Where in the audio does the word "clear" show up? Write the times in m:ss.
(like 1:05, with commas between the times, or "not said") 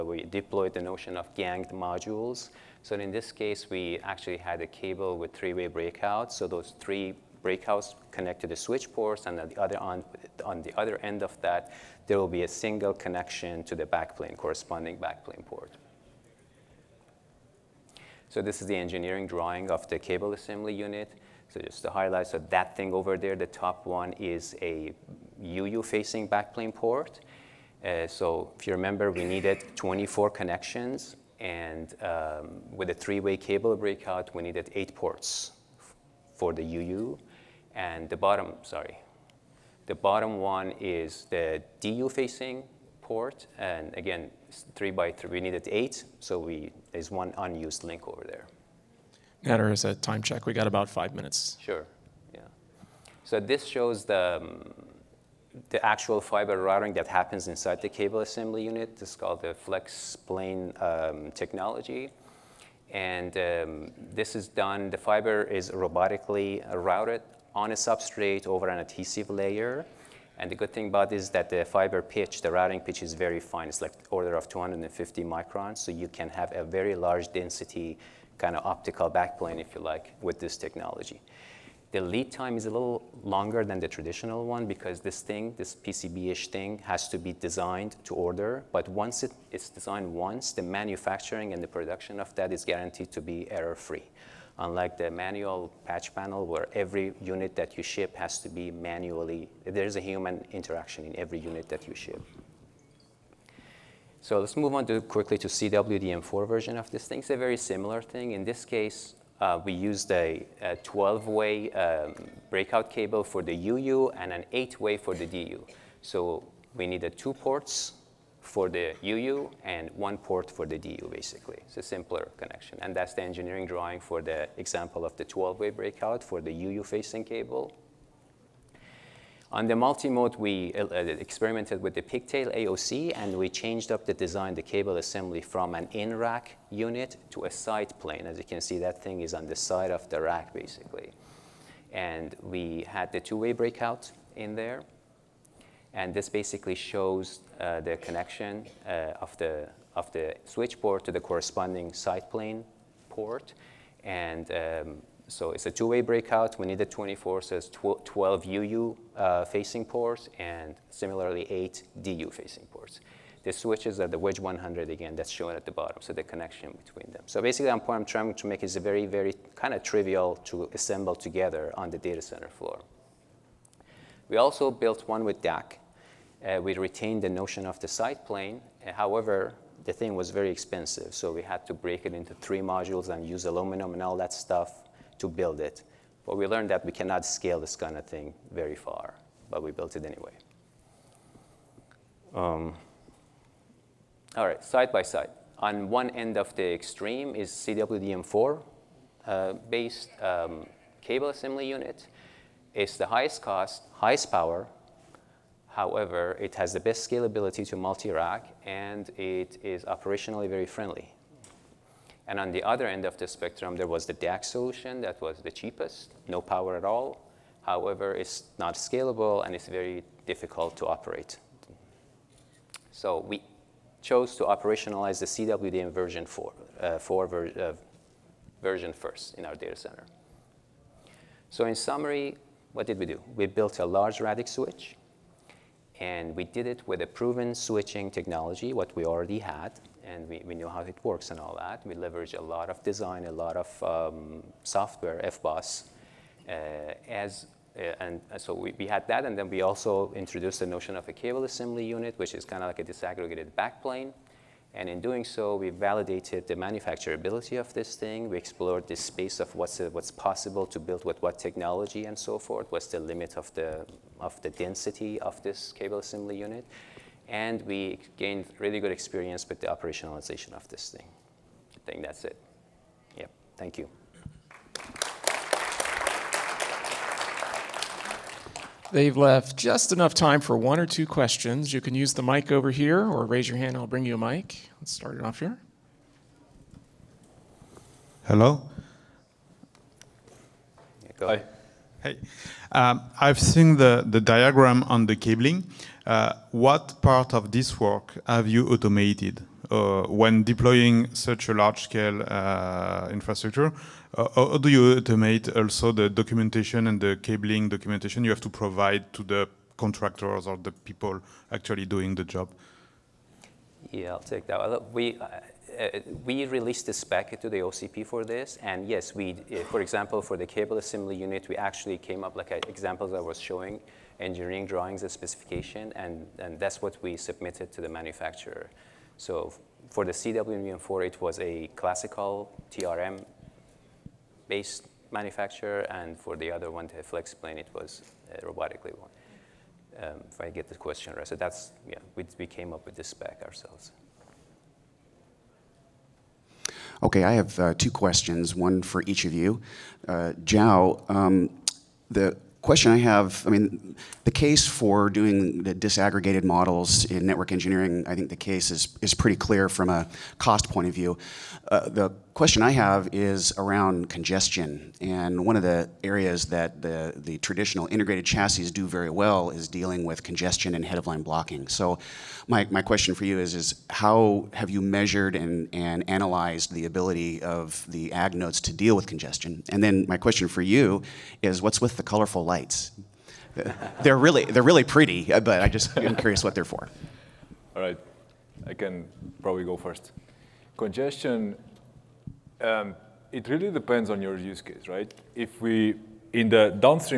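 5:59.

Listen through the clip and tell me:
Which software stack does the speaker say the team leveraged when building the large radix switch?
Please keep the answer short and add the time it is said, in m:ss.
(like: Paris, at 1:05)
FBOSS, at 4:05.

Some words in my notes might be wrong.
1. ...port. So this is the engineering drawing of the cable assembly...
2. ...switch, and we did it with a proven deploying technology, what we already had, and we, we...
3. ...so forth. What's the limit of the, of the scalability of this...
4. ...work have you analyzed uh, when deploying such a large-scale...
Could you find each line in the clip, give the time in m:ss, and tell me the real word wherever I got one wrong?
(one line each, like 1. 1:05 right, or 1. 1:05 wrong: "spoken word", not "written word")
1. 0:15 right
2. 3:54 wrong: "switching", not "deploying"
3. 4:22 wrong: "density", not "scalability"
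4. 4:57 wrong: "automated", not "analyzed".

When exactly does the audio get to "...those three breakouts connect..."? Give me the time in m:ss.
0:06.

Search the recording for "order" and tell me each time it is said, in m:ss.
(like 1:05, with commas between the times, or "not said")
1:14, 1:28.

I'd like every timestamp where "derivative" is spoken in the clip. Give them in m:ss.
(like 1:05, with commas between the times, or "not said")
not said.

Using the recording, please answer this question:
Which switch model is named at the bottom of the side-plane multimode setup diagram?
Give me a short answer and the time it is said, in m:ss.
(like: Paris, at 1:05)
Wedge 100, at 2:44.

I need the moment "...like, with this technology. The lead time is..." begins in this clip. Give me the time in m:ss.
1:19.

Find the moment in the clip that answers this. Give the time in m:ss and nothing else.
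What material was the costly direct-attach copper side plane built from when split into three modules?
3:03.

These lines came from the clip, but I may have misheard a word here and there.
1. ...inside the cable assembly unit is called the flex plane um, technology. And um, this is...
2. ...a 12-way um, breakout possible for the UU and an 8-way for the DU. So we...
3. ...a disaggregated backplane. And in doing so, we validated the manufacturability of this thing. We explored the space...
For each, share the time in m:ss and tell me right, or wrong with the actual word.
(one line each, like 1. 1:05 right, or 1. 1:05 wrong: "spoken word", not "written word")
1. 0:57 right
2. 1:50 wrong: "cable", not "possible"
3. 4:12 right.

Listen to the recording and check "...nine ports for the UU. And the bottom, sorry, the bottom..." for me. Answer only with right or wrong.
wrong.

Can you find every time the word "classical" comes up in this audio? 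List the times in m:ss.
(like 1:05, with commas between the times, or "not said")
5:31.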